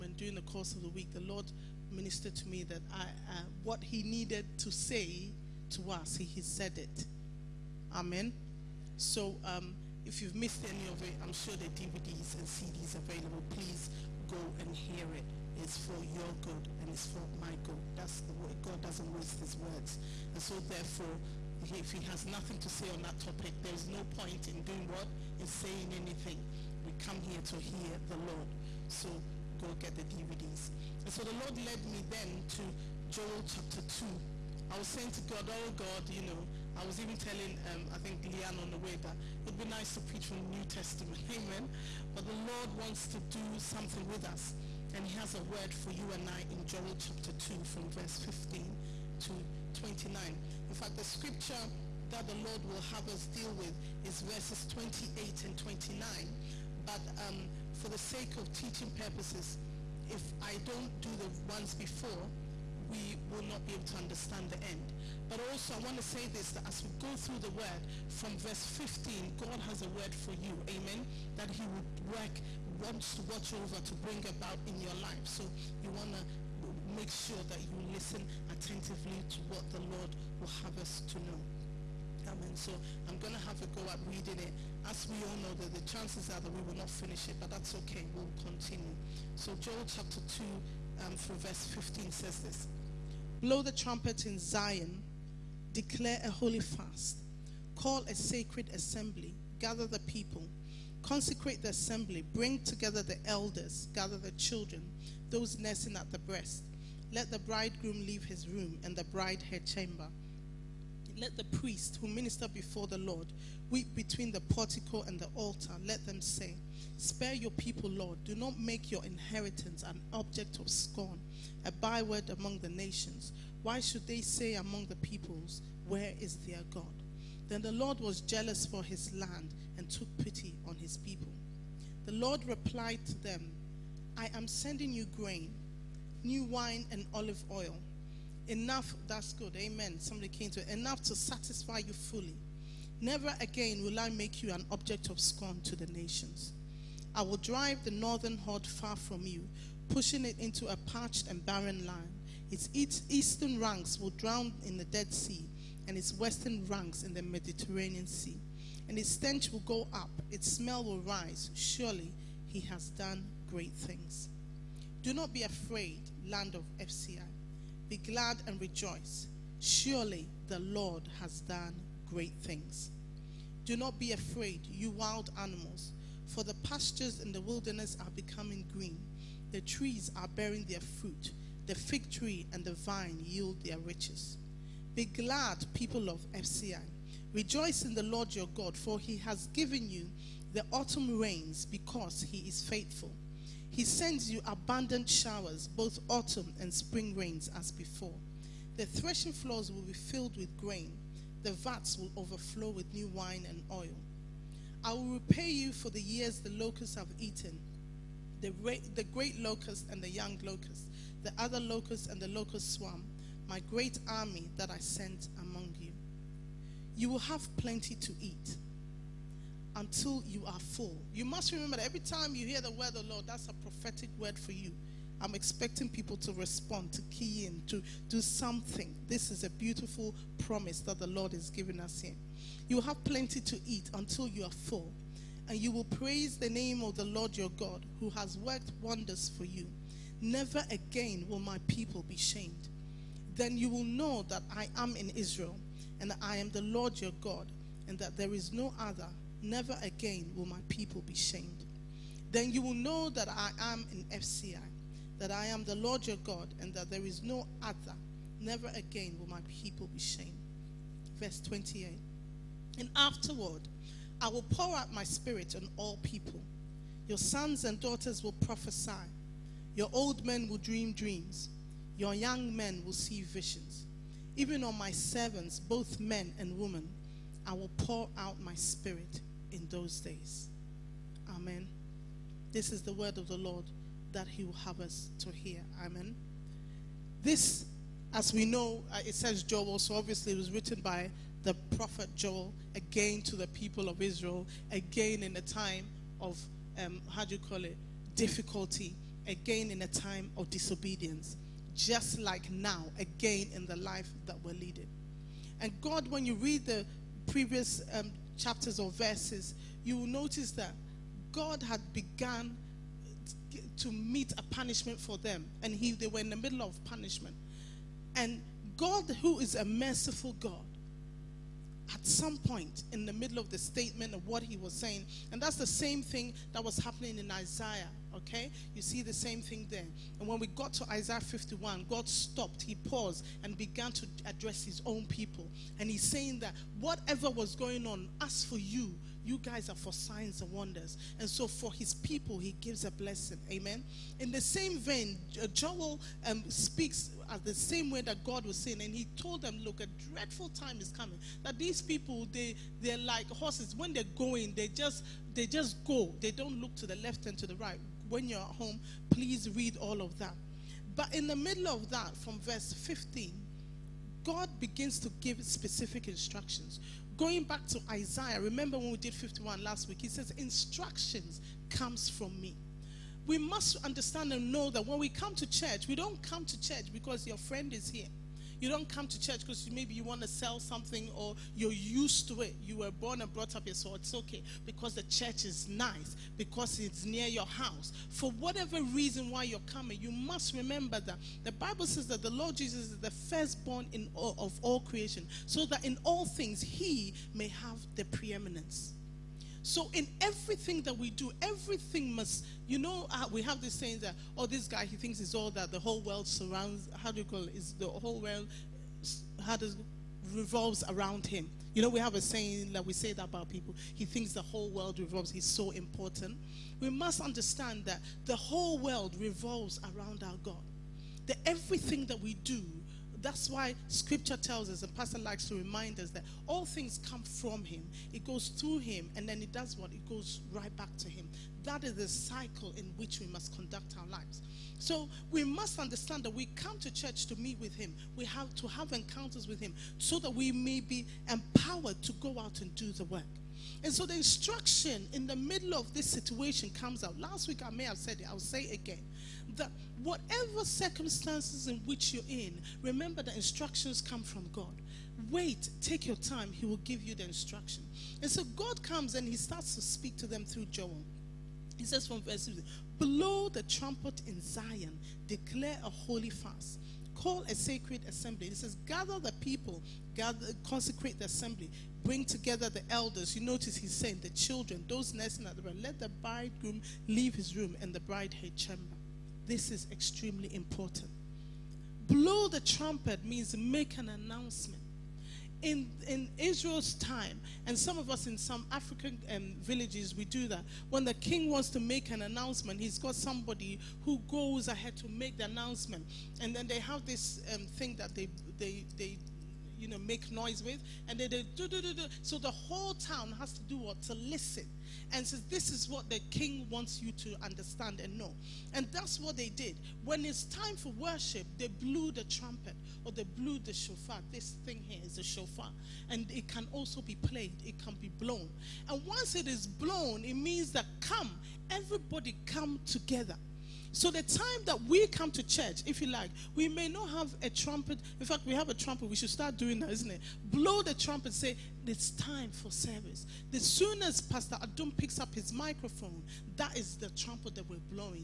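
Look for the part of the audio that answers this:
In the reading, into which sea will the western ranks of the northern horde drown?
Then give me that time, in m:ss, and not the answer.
2:37.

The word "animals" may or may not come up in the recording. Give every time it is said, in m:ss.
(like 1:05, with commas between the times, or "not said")
2:55.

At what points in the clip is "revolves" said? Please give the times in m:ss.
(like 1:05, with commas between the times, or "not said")
6:50, 6:54, 6:59.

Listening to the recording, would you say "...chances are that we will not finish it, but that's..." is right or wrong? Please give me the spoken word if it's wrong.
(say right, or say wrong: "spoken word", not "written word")
right.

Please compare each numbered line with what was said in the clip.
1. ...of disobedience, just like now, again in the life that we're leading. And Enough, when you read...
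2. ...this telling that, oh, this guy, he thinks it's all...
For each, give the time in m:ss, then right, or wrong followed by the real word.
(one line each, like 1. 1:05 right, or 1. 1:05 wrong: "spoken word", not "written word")
1. 5:00 wrong: "God", not "Enough"
2. 6:43 wrong: "saying", not "telling".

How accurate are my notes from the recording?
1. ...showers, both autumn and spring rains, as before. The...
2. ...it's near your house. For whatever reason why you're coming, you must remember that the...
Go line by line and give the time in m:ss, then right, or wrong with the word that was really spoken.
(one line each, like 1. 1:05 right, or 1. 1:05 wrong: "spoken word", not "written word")
1. 3:15 right
2. 6:26 right.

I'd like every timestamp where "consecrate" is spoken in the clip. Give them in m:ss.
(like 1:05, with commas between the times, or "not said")
1:41, 7:50.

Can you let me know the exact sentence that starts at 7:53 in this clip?
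You notice he's saying the children, those nursing at the bride, let the bridegroom leave his room and the bride her chamber.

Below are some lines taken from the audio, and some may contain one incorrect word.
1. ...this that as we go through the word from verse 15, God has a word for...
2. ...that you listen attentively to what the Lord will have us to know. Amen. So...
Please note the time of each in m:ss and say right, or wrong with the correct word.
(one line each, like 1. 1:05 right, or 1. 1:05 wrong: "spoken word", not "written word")
1. 1:06 right
2. 1:17 right.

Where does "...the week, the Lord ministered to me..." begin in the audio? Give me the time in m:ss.
0:00.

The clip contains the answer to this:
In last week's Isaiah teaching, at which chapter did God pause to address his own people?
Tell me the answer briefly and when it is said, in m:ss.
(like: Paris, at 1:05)
51, at 5:30.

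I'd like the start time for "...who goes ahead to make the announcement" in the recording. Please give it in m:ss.
8:14.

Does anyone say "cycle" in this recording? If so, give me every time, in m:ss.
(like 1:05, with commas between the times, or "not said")
7:12.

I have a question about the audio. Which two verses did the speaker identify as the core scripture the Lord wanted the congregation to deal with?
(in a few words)
28 and 29.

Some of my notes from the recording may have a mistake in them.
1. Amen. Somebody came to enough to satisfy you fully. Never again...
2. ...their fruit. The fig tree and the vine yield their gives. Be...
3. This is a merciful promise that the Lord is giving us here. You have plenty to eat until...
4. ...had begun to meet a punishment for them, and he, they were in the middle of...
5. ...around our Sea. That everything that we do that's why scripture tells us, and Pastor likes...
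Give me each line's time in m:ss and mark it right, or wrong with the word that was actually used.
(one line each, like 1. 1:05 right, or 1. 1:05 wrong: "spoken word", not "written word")
1. 2:19 right
2. 3:00 wrong: "riches", not "gives"
3. 3:49 wrong: "beautiful", not "merciful"
4. 5:11 right
5. 6:59 wrong: "God", not "Sea".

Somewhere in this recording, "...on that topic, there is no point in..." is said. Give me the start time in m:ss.
0:22.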